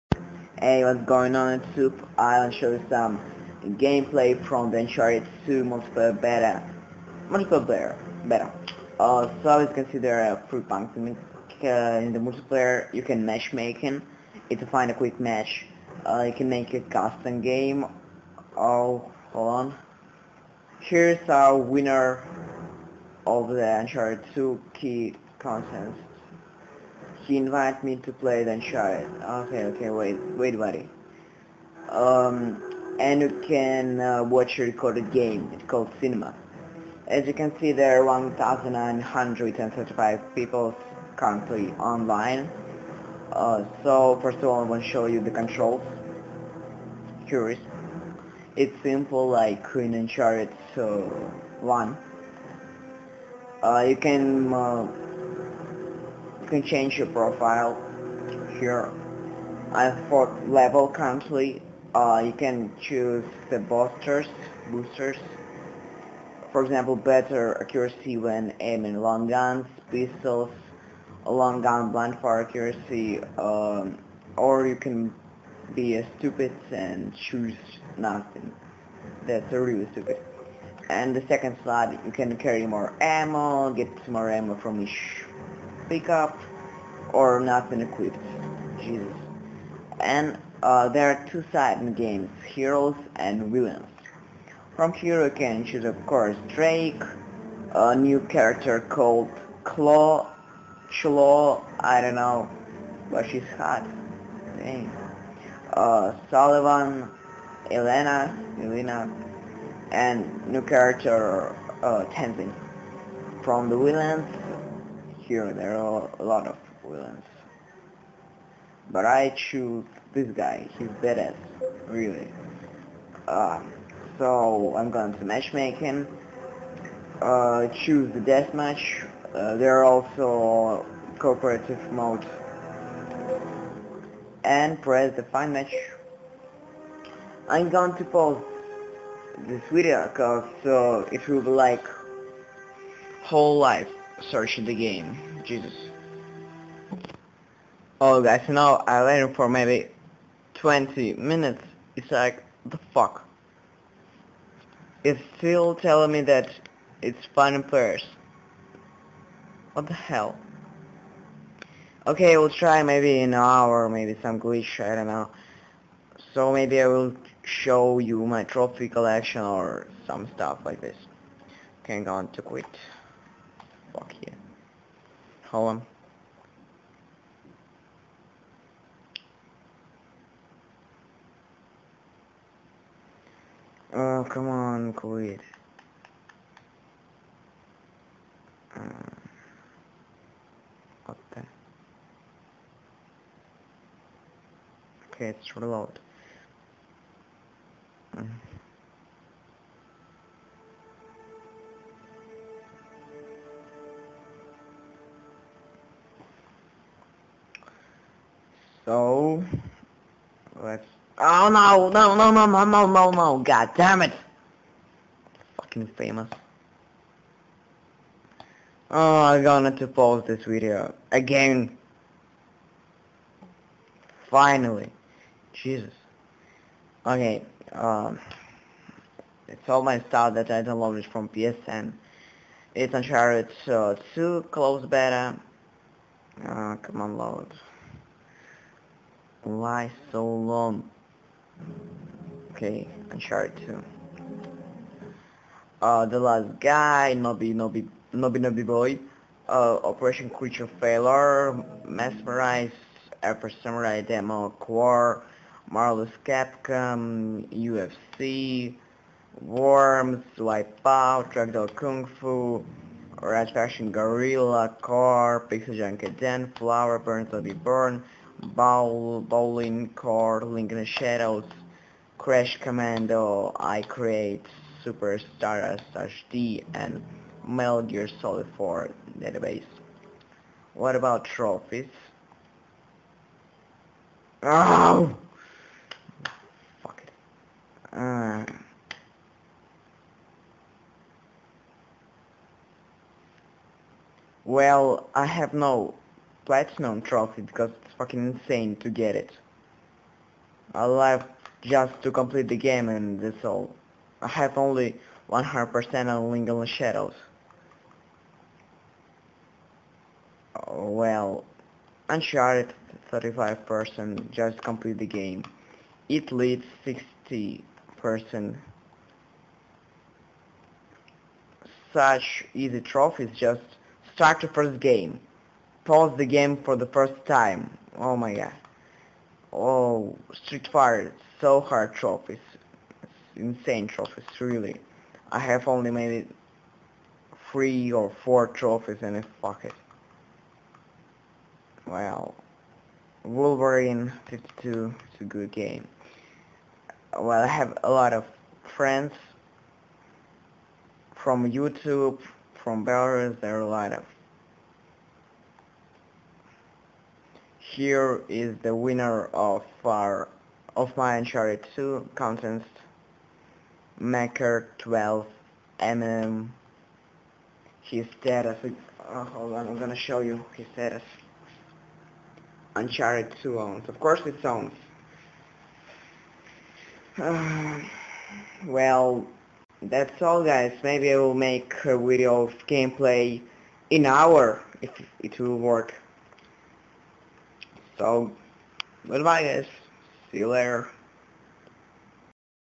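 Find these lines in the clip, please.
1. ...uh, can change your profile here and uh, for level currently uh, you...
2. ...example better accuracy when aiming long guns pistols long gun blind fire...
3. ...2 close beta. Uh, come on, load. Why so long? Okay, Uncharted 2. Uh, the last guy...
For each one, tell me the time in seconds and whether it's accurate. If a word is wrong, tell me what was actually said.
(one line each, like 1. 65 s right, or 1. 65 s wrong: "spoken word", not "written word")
1. 54 s right
2. 66 s right
3. 234 s right.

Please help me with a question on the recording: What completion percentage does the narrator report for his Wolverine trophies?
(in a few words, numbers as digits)
52%.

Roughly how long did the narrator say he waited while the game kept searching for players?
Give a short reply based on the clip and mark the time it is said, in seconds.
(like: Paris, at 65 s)
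20 minutes, at 150 s.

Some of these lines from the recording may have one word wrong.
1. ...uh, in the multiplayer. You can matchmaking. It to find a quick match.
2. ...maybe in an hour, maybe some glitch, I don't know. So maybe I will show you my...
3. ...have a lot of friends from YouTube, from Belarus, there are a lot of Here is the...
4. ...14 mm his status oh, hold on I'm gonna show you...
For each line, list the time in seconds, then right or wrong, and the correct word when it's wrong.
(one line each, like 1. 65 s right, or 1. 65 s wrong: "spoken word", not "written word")
1. 11 s right
2. 162 s right
3. 347 s right
4. 364 s wrong: "12", not "14".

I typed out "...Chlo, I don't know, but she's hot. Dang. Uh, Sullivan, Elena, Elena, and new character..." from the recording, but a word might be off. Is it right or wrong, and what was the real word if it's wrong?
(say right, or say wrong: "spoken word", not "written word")
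right.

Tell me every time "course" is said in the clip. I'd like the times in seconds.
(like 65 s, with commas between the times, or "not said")
96 s, 374 s.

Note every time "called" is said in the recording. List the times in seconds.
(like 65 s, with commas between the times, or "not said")
35 s, 98 s.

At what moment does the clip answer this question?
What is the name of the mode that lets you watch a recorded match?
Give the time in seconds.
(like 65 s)
36 s.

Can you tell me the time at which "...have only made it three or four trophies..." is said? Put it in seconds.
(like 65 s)
335 s.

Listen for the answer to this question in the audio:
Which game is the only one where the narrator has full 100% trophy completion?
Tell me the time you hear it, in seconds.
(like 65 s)
306 s.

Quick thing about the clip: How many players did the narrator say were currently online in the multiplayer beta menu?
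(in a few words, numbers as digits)
1,935.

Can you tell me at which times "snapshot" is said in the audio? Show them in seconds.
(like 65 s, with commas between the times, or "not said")
not said.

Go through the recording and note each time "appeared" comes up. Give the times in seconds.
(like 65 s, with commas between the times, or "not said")
not said.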